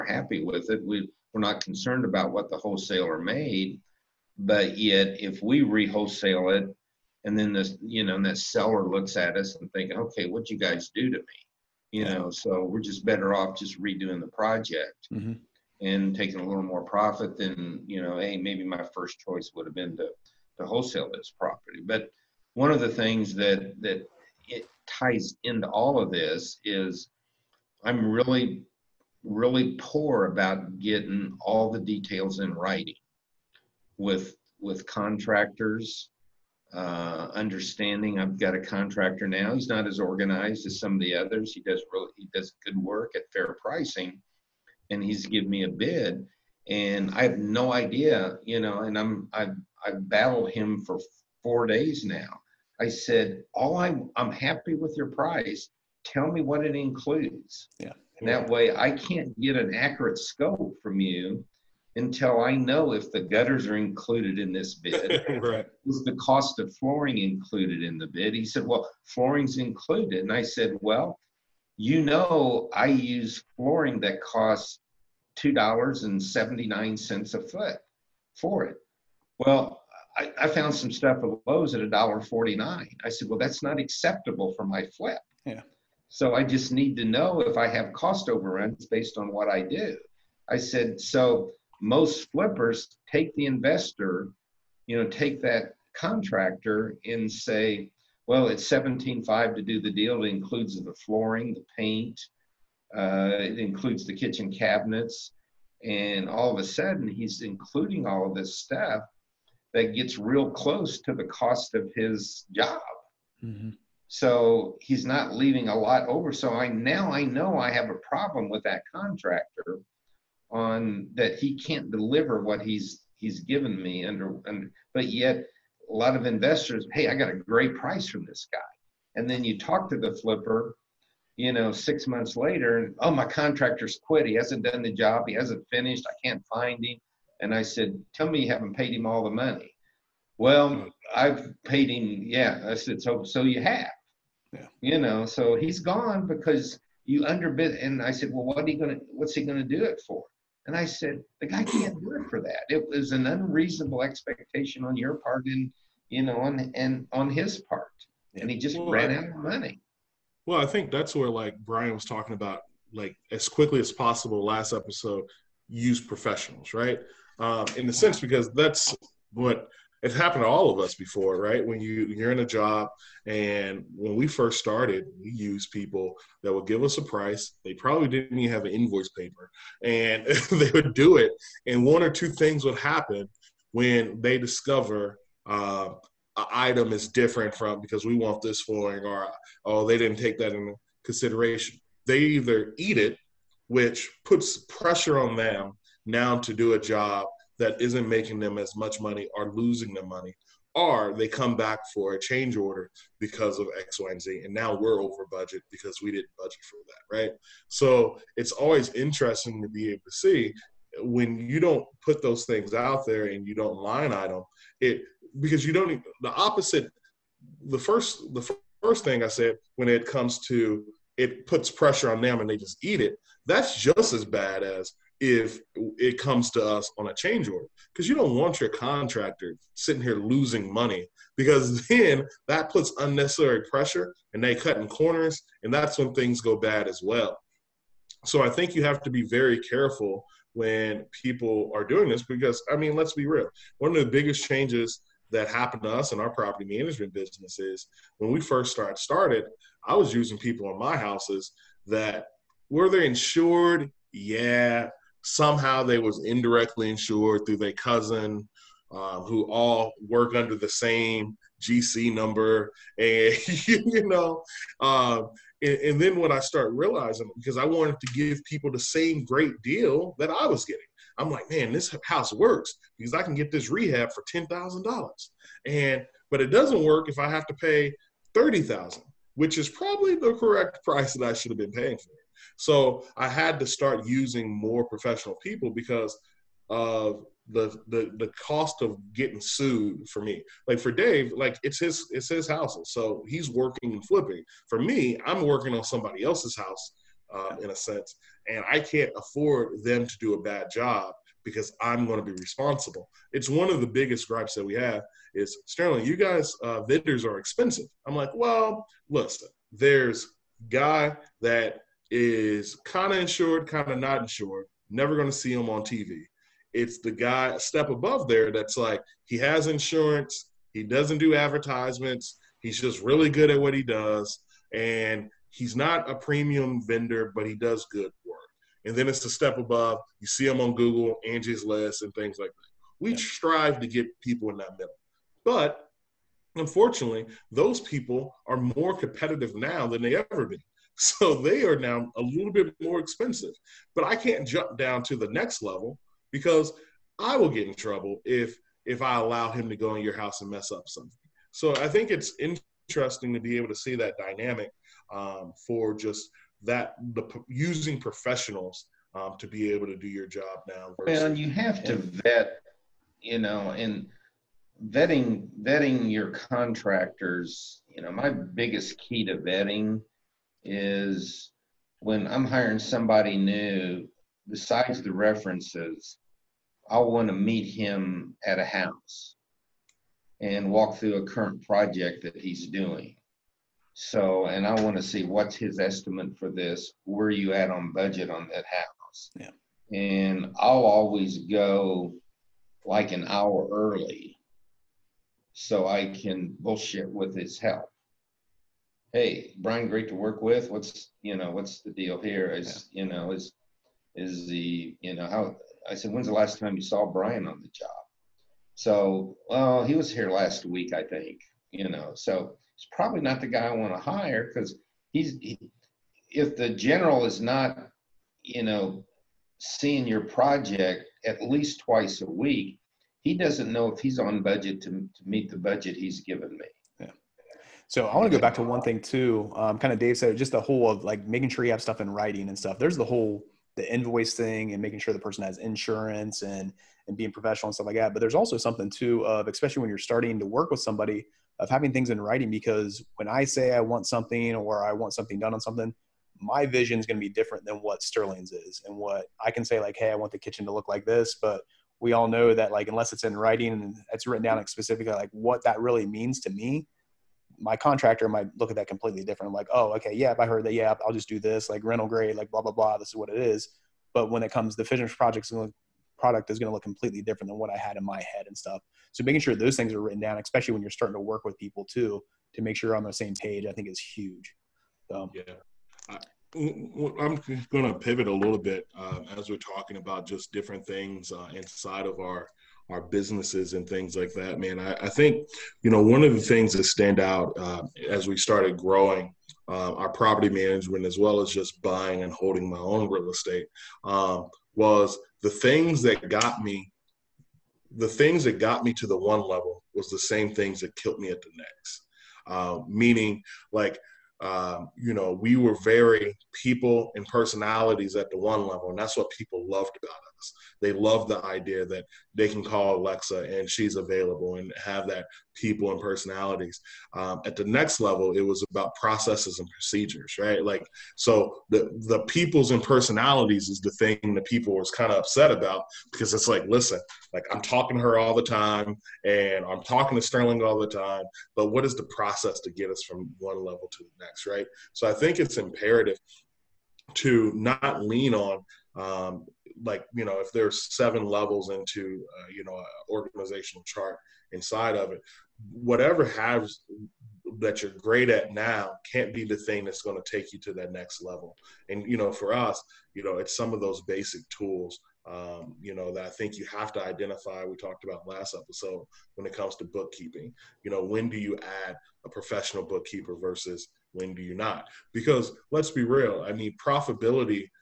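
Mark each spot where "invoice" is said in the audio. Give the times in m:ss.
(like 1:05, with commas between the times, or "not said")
2:58, 7:13.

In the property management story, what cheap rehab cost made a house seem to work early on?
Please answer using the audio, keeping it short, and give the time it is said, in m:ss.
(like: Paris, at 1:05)
$10,000, at 4:34.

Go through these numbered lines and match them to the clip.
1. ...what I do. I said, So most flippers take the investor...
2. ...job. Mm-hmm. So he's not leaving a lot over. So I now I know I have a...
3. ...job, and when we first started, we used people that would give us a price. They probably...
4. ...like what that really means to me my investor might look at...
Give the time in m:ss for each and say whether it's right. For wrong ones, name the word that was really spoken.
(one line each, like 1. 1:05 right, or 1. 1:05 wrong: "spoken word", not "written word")
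1. 1:29 right
2. 1:52 right
3. 2:52 right
4. 7:35 wrong: "contractor", not "investor".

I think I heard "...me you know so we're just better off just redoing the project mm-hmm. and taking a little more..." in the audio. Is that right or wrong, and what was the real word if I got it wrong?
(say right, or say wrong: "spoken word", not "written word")
right.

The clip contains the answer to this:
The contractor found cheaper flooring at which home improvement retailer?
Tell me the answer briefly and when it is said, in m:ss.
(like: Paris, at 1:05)
Lowe's, at 1:21.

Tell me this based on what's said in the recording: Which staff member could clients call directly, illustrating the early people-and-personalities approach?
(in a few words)
Alexa.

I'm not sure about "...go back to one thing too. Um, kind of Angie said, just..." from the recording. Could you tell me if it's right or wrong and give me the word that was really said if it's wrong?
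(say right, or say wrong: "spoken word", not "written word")
wrong: "Dave", not "Angie".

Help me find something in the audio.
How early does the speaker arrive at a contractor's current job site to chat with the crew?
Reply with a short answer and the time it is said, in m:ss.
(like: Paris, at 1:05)
an hour, at 6:33.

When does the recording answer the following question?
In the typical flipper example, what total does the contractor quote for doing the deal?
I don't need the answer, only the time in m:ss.
1:38.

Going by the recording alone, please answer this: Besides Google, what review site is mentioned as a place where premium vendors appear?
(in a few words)
Angie's List.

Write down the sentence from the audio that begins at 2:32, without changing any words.
It was an unreasonable expectation on your part and, you know, on, and on his part.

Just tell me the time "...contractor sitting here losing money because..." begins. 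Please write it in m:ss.
3:48.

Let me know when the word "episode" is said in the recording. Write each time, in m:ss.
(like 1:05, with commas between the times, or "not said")
2:44, 9:18.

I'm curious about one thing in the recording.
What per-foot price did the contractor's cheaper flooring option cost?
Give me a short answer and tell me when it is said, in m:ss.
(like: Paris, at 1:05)
$1.49, at 1:21.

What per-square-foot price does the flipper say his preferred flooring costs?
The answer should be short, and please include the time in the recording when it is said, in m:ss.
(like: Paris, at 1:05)
$2.79, at 1:15.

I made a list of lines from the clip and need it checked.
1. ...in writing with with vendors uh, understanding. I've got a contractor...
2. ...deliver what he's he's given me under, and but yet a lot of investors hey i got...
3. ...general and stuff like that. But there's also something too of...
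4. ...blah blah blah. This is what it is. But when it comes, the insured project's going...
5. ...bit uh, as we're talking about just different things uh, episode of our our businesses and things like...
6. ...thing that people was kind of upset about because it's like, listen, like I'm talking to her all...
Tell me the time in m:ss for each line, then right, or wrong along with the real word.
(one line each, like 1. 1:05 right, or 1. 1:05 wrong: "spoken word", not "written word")
1. 0:32 wrong: "contractors", not "vendors"
2. 2:01 right
3. 7:17 wrong: "professional", not "general"
4. 7:42 wrong: "finished", not "insured"
5. 7:58 wrong: "inside", not "episode"
6. 8:43 right.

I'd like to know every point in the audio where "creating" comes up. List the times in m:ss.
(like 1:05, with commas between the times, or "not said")
not said.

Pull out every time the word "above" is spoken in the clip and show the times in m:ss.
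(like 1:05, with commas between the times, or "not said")
5:17, 5:29.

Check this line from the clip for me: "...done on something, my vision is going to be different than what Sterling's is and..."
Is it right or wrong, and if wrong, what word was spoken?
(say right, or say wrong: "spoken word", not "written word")
right.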